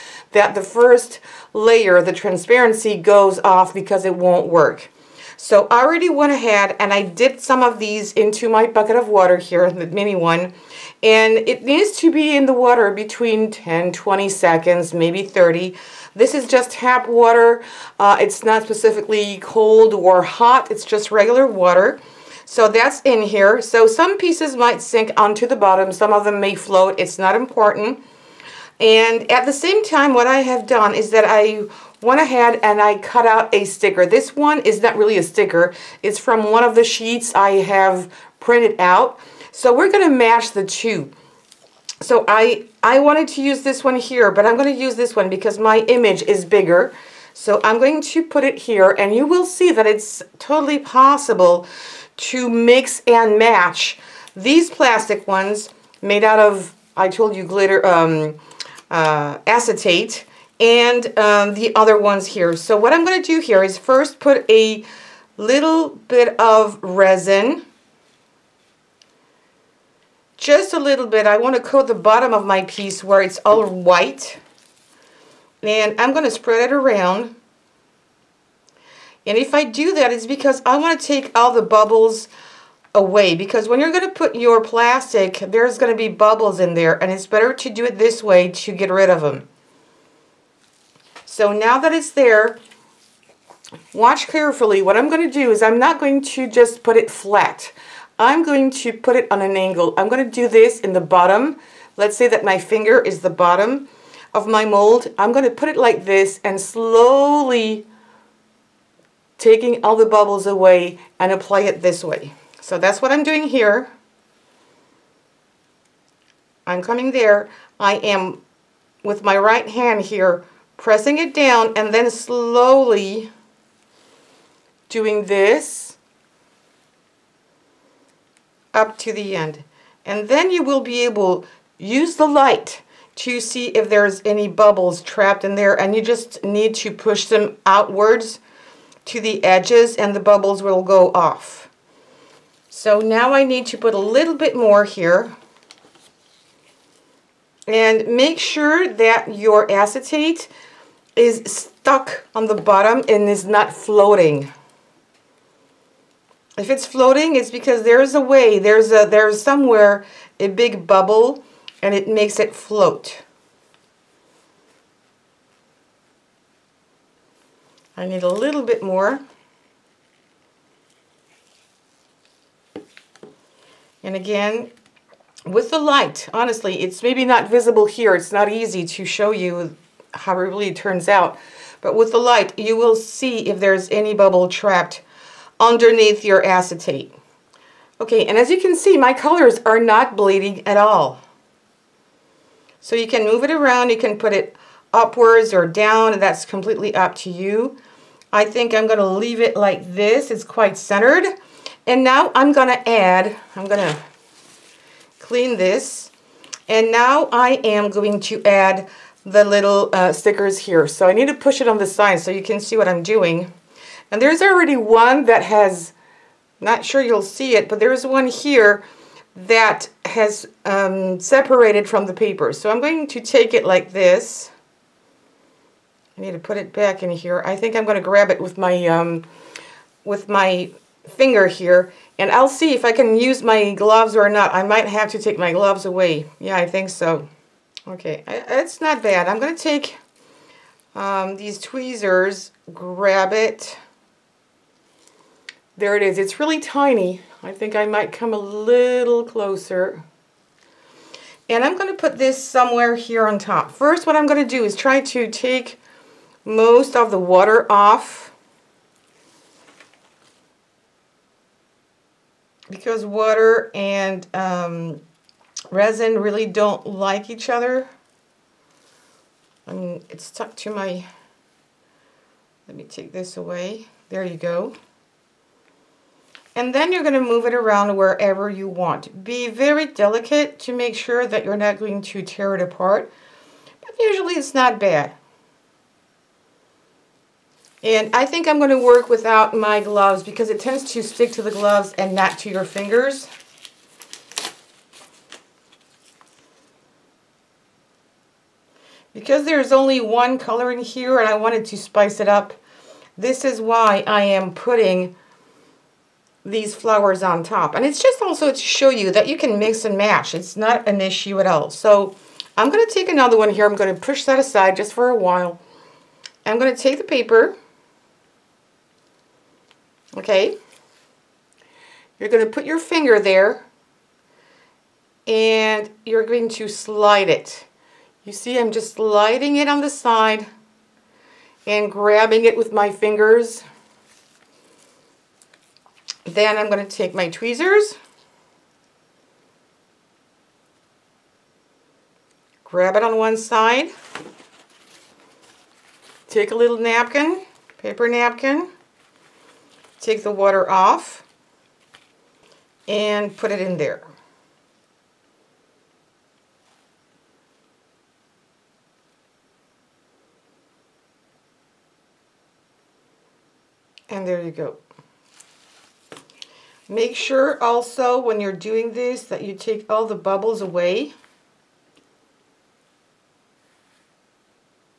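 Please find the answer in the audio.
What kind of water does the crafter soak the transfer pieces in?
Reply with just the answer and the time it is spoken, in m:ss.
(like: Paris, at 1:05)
tap water, at 0:16.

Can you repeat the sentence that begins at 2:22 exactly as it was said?
So now I need to put a little bit more here.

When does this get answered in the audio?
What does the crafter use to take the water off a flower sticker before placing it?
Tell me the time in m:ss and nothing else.
5:47.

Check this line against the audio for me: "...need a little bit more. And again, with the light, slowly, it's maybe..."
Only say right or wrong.
wrong.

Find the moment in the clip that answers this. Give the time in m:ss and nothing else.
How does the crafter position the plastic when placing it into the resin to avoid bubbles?
1:39.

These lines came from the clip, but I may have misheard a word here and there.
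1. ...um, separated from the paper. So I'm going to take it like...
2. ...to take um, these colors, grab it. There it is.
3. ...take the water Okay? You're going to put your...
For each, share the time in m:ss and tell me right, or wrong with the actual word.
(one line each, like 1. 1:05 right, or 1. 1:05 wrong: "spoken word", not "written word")
1. 3:40 right
2. 3:59 wrong: "tweezers", not "colors"
3. 5:16 wrong: "paper", not "water".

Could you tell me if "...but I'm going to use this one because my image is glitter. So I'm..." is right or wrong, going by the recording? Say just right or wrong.
wrong.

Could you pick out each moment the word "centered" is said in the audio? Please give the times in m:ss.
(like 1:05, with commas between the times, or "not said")
3:20.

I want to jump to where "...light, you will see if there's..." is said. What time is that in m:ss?
3:02.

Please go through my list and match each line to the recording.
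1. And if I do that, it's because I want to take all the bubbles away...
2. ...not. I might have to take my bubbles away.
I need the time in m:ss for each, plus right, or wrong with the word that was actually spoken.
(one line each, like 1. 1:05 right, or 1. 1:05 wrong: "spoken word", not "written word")
1. 1:19 right
2. 3:54 wrong: "gloves", not "bubbles".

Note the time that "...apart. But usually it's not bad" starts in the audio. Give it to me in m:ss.
4:42.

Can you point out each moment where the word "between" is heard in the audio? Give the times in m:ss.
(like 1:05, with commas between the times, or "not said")
0:12.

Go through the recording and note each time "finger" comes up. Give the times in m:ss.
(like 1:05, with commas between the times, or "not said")
1:42, 3:51, 4:52, 5:22, 5:32.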